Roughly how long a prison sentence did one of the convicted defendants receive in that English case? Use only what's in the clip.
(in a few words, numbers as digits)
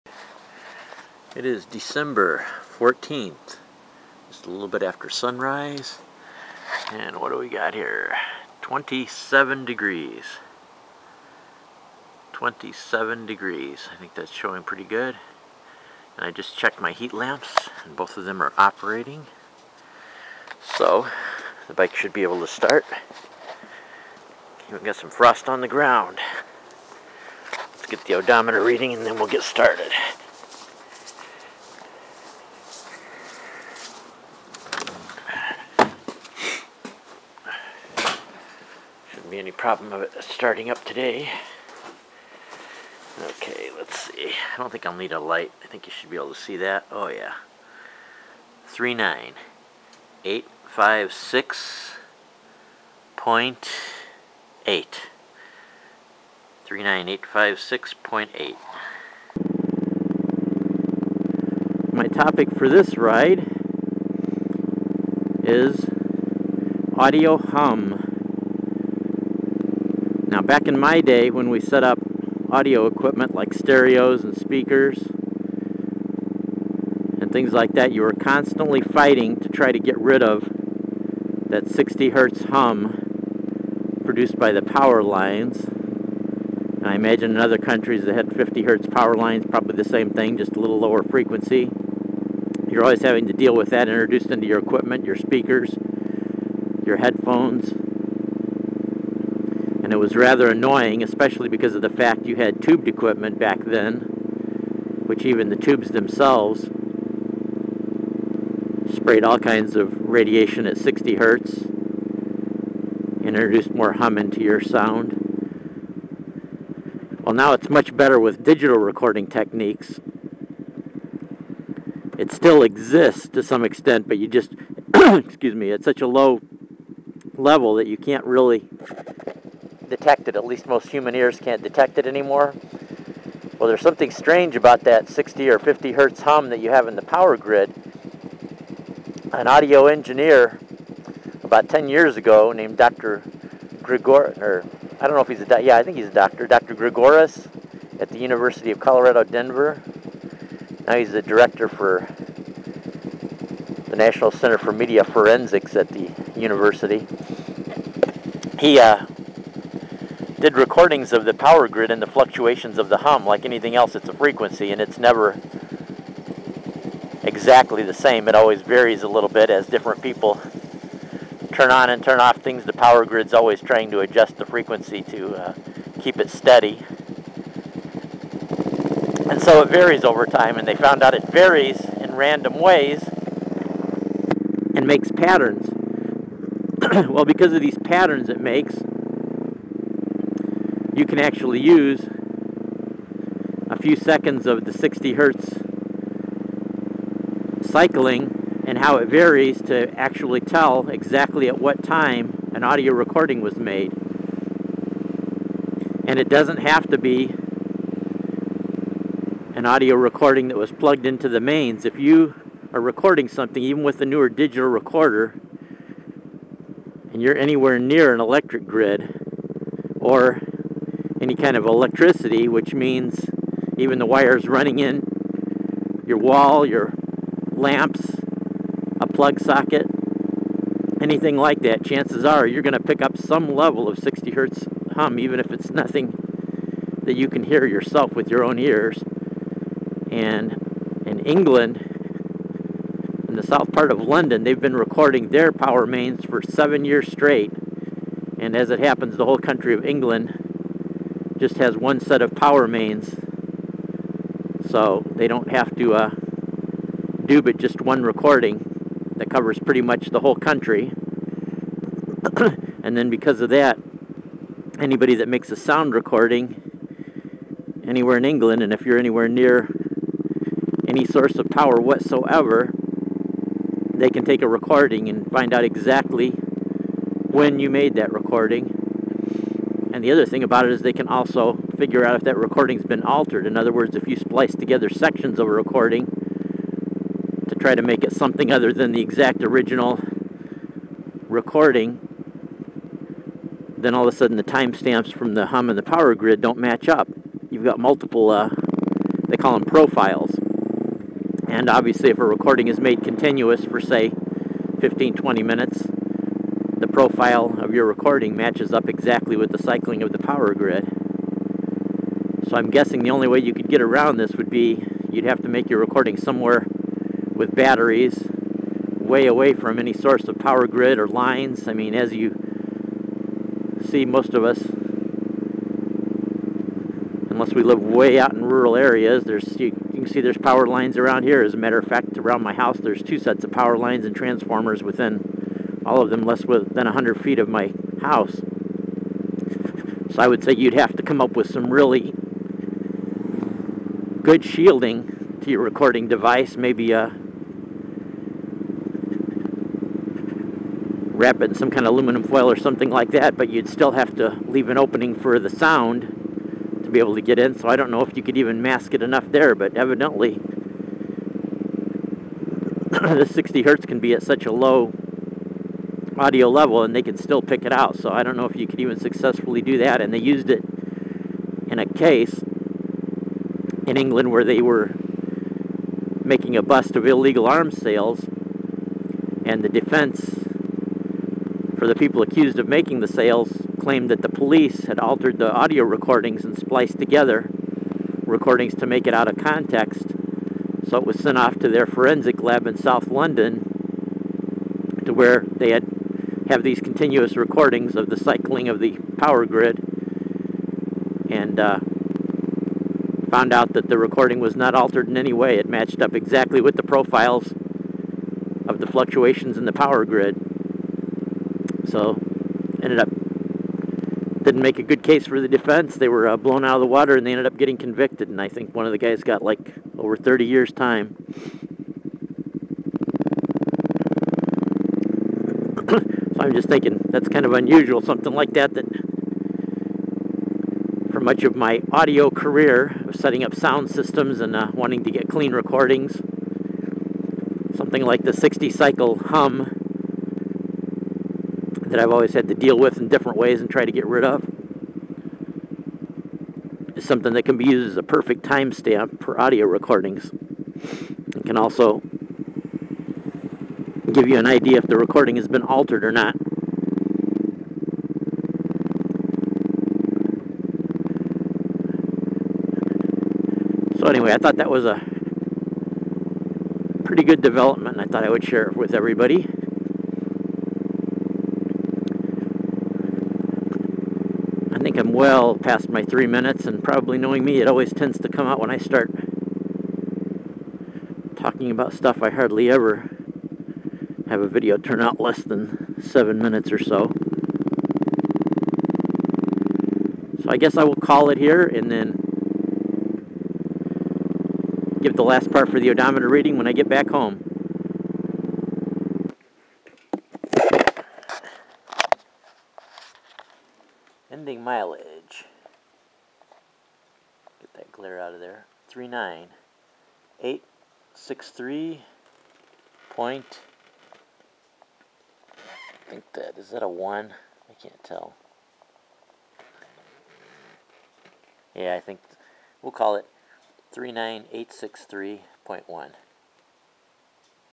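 over 30 years.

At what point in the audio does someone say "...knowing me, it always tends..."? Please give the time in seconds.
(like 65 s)
477 s.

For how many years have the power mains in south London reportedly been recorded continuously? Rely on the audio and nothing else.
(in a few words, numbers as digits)
7.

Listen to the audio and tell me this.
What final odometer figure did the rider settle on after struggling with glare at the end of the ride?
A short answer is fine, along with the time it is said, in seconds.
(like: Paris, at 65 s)
39863.1, at 523 s.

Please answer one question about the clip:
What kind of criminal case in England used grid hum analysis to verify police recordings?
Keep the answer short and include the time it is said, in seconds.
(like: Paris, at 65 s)
illegal arms sales, at 377 s.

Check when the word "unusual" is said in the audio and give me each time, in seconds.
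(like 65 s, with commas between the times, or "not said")
427 s.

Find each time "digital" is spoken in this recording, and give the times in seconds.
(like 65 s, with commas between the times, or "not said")
118 s, 214 s.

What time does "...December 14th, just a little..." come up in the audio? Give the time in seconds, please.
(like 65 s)
1 s.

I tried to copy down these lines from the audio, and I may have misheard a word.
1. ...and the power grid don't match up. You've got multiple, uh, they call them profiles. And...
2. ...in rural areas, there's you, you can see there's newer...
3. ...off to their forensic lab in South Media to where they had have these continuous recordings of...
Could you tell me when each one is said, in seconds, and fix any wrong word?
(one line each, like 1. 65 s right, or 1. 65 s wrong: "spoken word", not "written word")
1. 295 s right
2. 328 s wrong: "power", not "newer"
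3. 391 s wrong: "London", not "Media".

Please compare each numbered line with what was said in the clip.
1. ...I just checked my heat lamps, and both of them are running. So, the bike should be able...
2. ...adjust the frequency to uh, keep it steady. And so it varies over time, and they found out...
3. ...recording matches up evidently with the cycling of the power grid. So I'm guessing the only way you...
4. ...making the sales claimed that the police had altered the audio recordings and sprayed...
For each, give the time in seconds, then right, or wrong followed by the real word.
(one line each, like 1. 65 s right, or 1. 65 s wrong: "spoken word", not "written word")
1. 16 s wrong: "operating", not "running"
2. 173 s right
3. 307 s wrong: "exactly", not "evidently"
4. 382 s wrong: "spliced", not "sprayed".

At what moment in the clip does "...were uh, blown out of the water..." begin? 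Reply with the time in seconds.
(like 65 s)
416 s.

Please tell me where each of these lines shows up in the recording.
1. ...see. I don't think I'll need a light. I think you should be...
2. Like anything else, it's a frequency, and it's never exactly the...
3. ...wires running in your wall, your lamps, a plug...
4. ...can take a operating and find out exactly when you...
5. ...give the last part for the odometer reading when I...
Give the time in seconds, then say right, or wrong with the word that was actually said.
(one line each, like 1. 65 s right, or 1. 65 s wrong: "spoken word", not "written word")
1. 44 s right
2. 163 s right
3. 224 s right
4. 274 s wrong: "recording", not "operating"
5. 495 s right.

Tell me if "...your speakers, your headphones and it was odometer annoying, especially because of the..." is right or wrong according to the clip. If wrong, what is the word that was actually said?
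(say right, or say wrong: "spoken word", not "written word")
wrong: "rather", not "odometer".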